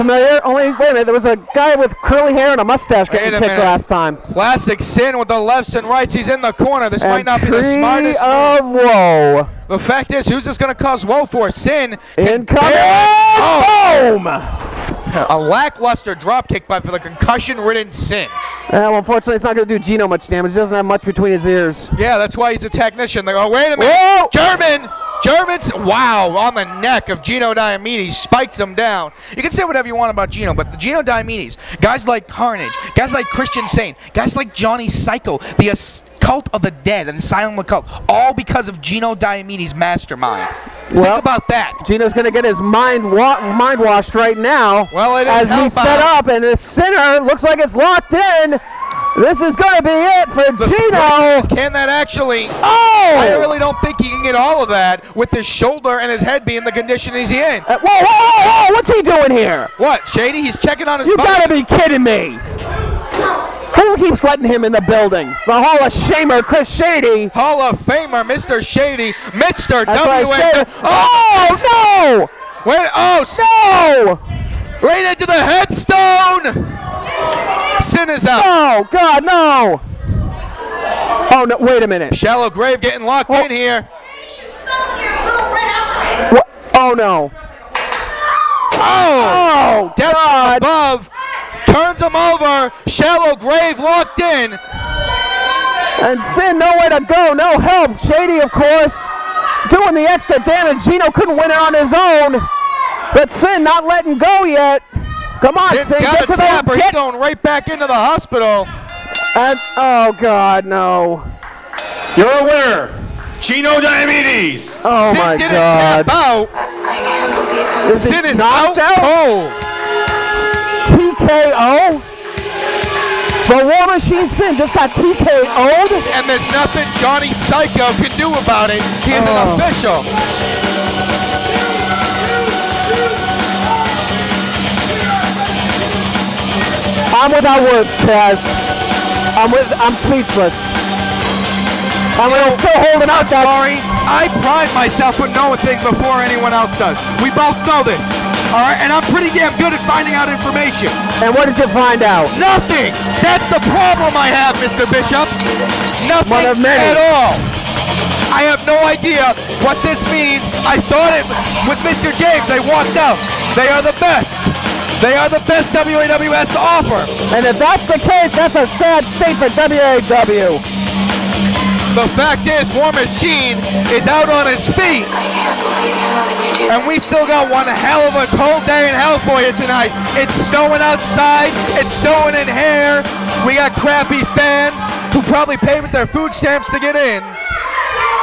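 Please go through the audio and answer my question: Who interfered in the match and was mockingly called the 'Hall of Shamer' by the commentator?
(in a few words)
Chris Shady.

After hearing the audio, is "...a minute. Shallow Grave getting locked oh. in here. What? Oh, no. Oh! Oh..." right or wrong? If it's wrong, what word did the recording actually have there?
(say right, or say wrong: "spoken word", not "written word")
right.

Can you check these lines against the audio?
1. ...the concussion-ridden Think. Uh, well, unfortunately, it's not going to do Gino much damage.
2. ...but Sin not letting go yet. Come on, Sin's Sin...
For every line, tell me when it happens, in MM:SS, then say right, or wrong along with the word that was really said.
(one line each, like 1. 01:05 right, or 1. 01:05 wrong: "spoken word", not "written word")
1. 00:16 wrong: "Sin", not "Think"
2. 01:43 right.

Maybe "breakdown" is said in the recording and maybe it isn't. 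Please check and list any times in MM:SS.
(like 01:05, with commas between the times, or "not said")
not said.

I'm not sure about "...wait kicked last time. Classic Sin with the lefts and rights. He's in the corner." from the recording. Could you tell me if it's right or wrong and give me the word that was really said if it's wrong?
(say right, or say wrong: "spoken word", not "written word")
right.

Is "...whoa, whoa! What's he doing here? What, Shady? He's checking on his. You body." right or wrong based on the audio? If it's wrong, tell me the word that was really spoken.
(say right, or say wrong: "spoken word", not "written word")
right.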